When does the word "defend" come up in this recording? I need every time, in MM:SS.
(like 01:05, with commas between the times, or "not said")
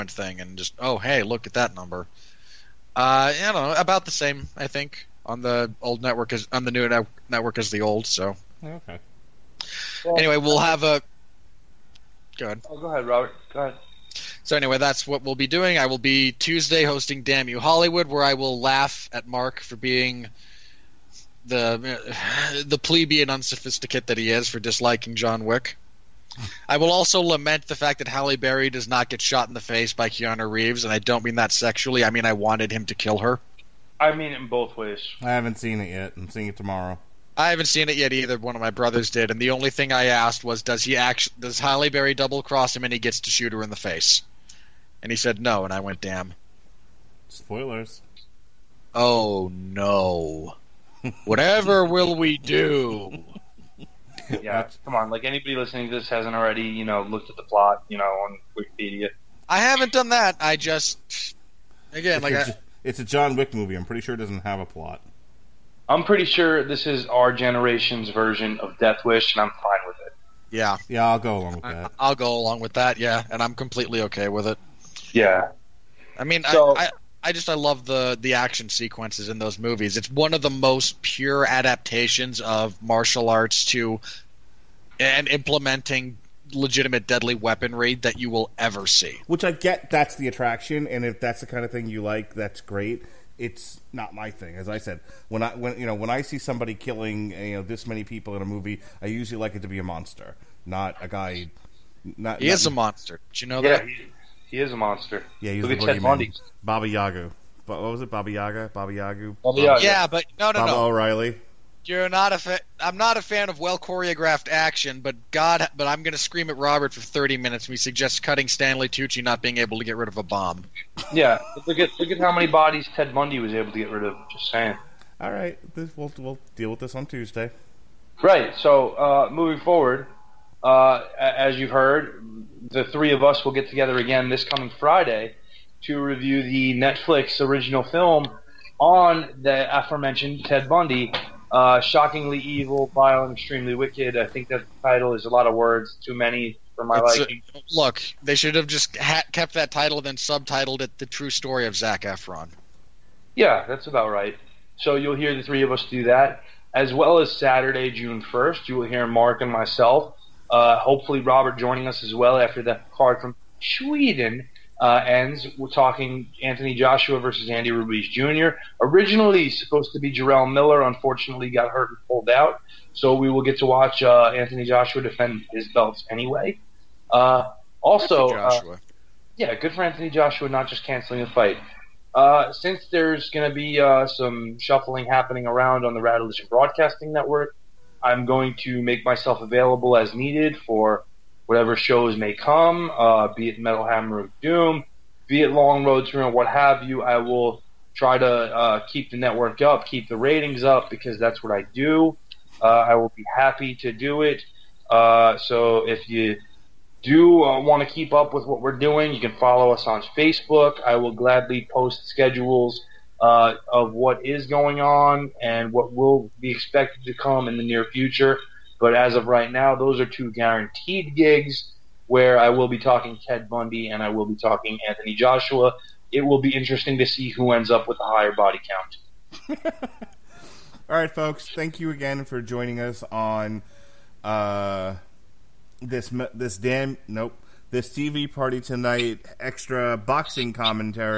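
02:55.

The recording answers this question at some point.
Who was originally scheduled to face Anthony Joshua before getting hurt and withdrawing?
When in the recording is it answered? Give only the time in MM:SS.
02:50.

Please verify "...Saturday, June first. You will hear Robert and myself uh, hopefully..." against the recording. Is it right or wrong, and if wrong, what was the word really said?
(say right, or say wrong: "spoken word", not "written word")
wrong: "Mark", not "Robert".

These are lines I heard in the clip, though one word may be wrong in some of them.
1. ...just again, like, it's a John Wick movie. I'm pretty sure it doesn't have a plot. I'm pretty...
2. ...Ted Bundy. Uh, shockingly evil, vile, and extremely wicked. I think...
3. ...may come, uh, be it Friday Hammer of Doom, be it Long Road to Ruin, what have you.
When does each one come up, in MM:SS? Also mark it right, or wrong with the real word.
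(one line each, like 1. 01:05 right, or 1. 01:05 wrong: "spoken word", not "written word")
1. 01:00 right
2. 02:20 right
3. 03:12 wrong: "Metal", not "Friday".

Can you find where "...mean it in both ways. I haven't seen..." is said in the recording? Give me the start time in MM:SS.
00:34.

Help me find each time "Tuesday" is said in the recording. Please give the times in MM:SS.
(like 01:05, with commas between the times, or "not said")
00:16, 02:07.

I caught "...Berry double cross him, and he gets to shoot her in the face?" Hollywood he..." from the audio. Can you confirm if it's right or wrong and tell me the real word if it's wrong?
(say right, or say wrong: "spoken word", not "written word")
wrong: "And", not "Hollywood".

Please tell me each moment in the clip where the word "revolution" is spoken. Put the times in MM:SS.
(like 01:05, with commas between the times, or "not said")
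not said.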